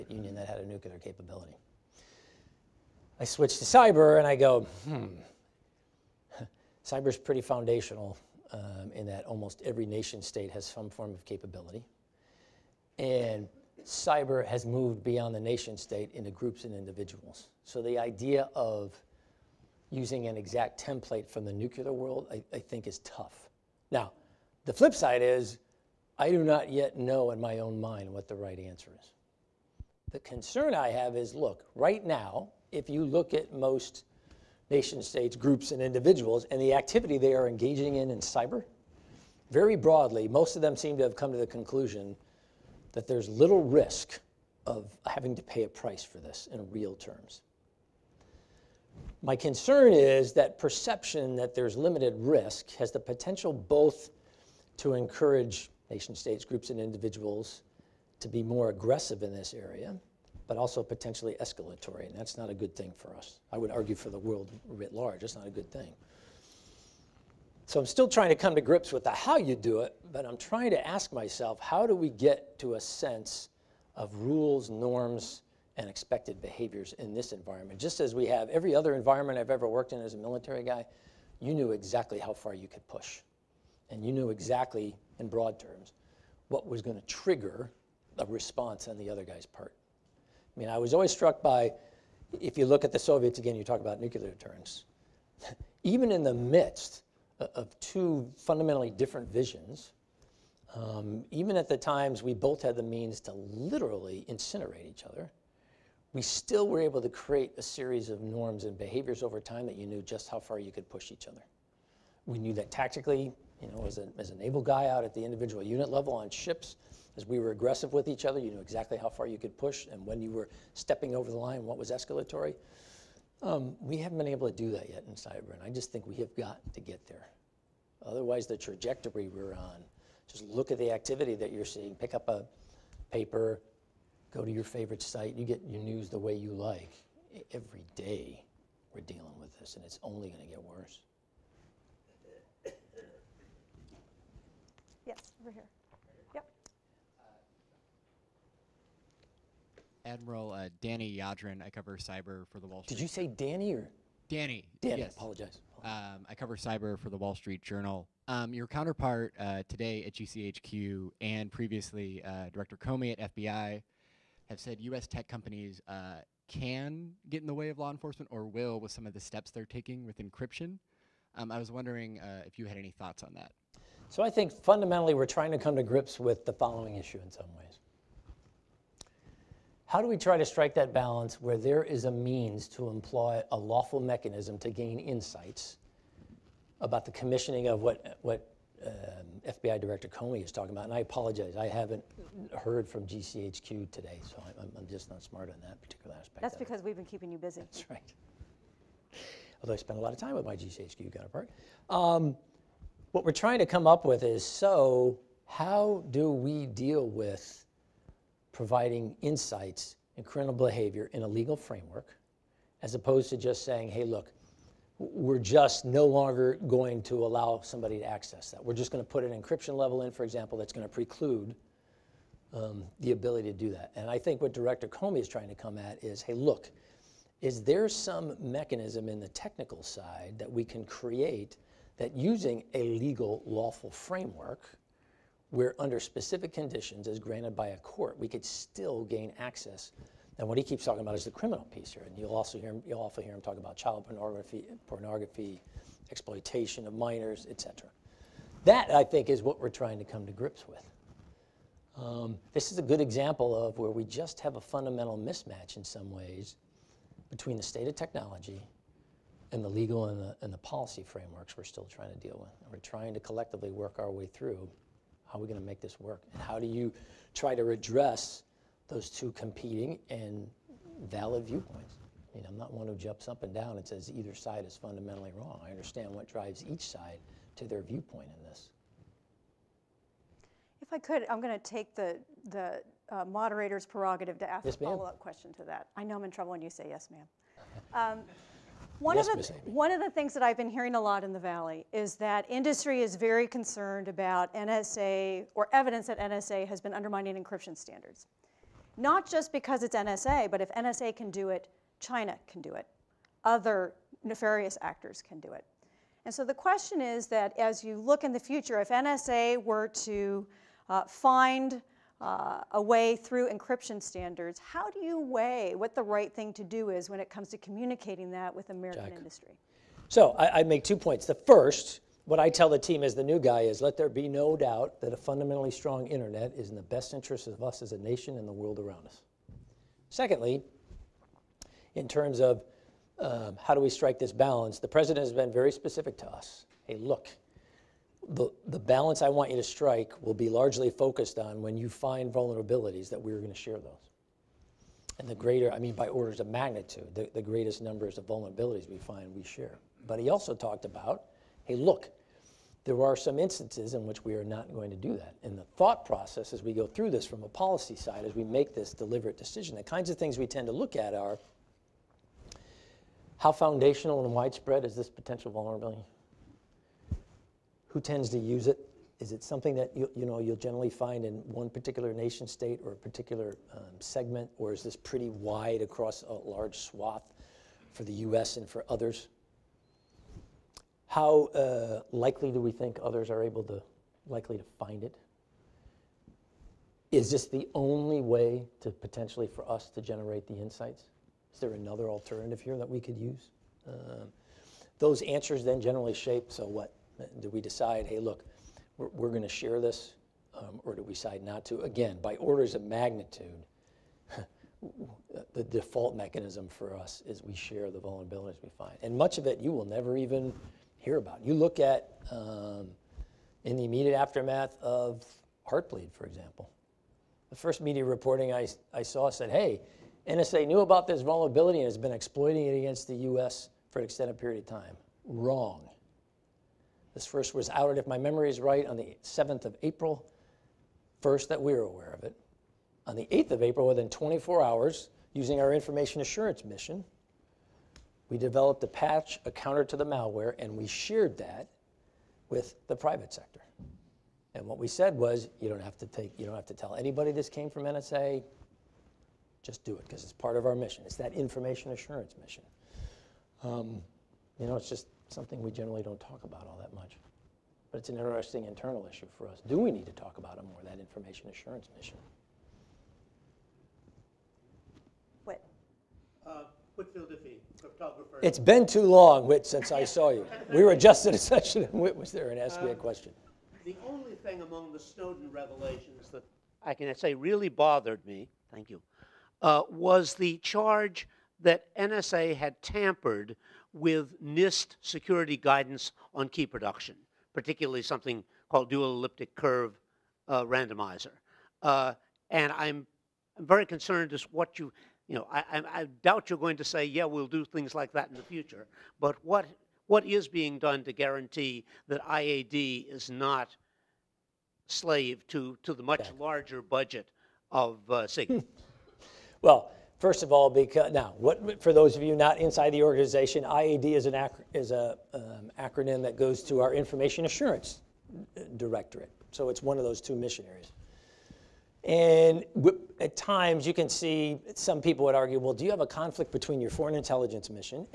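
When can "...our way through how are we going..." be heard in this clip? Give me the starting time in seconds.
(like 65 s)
263 s.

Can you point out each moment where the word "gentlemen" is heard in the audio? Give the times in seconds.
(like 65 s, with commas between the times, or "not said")
not said.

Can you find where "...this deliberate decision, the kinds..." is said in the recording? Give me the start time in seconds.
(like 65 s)
358 s.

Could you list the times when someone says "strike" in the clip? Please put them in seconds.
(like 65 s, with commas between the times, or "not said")
180 s, 333 s, 339 s.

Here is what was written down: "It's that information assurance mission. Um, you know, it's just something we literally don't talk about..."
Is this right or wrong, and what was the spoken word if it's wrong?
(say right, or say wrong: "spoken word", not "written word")
wrong: "generally", not "literally".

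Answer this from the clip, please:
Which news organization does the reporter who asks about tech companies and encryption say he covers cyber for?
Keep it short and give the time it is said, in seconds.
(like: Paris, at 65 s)
Wall Street Journal, at 157 s.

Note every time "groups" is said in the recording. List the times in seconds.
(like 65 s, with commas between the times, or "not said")
16 s, 35 s, 56 s.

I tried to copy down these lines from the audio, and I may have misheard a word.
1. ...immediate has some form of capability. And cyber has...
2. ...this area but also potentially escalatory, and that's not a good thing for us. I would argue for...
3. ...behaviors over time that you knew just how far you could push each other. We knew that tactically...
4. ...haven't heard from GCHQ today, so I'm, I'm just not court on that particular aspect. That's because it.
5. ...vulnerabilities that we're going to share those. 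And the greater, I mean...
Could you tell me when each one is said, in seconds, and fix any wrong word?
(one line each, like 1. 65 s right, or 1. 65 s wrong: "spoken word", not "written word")
1. 10 s wrong: "state", not "immediate"
2. 59 s right
3. 108 s right
4. 191 s wrong: "smart", not "court"
5. 342 s right.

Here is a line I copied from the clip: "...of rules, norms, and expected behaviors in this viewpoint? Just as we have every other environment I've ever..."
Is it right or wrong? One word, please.
wrong.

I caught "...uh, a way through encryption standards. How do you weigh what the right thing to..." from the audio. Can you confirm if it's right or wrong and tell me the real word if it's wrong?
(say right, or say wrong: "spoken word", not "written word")
right.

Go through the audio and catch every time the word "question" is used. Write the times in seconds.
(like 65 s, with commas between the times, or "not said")
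285 s, 306 s, 472 s.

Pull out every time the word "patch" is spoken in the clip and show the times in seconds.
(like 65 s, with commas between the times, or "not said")
438 s.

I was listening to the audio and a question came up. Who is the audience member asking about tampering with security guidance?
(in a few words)
Whitfield Diffie.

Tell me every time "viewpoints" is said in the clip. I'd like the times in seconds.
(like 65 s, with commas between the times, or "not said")
271 s, 277 s.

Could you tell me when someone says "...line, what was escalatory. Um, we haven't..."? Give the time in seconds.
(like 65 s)
121 s.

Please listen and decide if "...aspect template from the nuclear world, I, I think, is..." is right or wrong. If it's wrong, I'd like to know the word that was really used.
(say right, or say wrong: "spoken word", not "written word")
wrong: "exact", not "aspect".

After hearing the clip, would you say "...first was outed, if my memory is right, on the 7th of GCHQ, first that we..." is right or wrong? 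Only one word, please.
wrong.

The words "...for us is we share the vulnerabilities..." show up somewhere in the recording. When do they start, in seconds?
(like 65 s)
406 s.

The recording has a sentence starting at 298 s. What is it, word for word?
Not just because it's NSA, but if NSA can do it, China can do it.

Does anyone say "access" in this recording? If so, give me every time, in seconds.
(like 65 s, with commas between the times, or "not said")
218 s, 239 s.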